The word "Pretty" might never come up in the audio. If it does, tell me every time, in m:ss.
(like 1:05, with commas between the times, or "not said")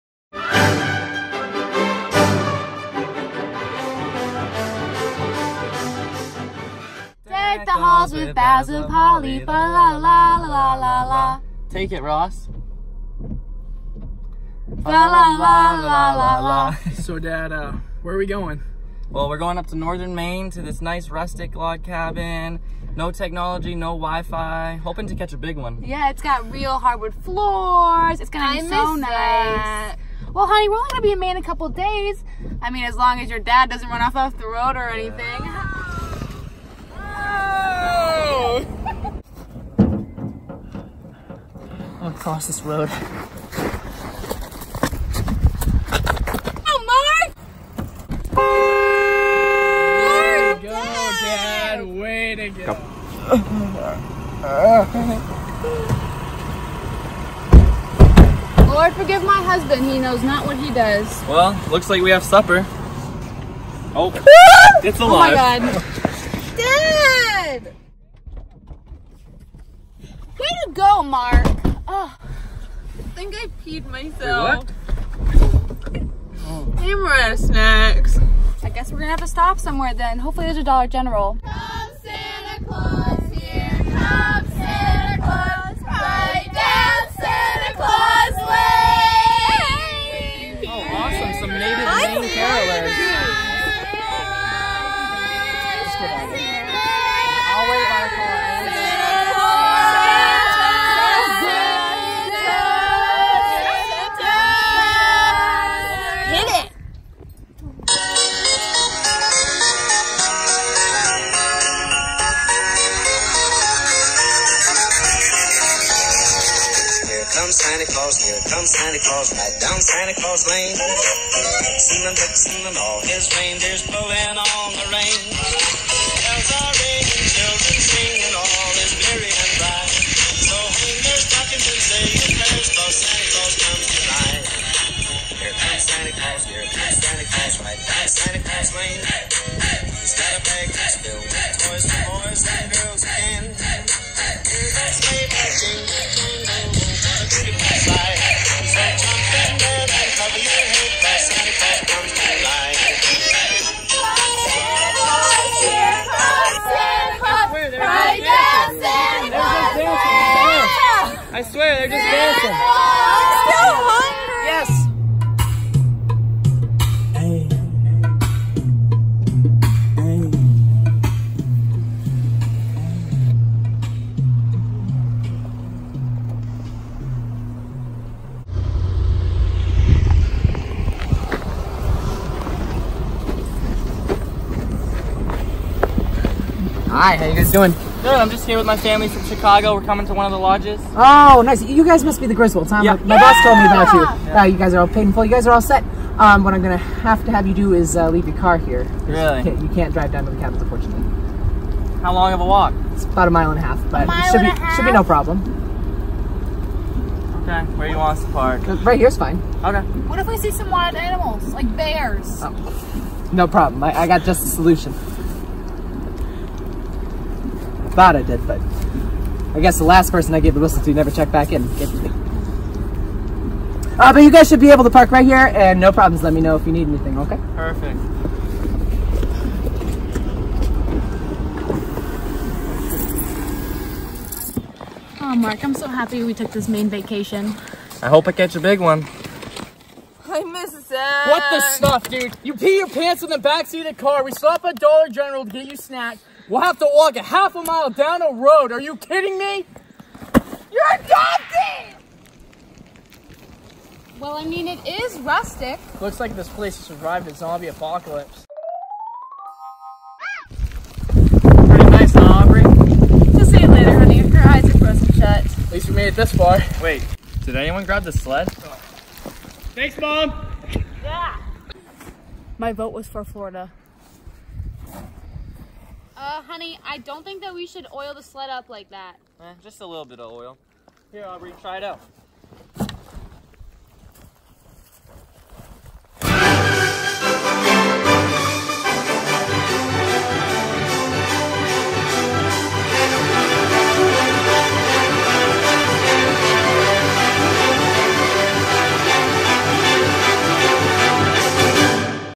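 4:21.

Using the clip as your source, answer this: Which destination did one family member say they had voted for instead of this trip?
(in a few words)
Florida.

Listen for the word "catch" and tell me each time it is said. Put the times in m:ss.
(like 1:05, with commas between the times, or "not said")
0:25, 3:58.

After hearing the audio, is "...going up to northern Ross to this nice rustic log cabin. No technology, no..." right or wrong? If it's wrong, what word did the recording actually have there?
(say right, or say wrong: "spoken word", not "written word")
wrong: "Maine", not "Ross".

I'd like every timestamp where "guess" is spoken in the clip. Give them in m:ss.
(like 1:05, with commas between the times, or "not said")
1:18, 3:39.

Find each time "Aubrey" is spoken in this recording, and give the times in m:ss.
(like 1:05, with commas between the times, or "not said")
4:22, 4:41.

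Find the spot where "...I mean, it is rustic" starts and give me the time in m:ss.
4:14.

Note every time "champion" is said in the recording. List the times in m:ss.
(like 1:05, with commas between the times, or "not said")
not said.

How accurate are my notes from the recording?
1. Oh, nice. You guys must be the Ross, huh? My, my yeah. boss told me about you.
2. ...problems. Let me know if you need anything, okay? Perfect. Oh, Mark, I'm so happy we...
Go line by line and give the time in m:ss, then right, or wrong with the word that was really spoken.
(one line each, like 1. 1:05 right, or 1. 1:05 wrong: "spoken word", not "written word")
1. 3:10 wrong: "Griswolds", not "Ross"
2. 3:45 right.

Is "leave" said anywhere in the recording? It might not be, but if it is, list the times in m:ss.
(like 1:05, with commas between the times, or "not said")
3:18.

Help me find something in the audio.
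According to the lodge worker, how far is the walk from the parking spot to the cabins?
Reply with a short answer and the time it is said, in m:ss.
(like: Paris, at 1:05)
a mile and a half, at 3:23.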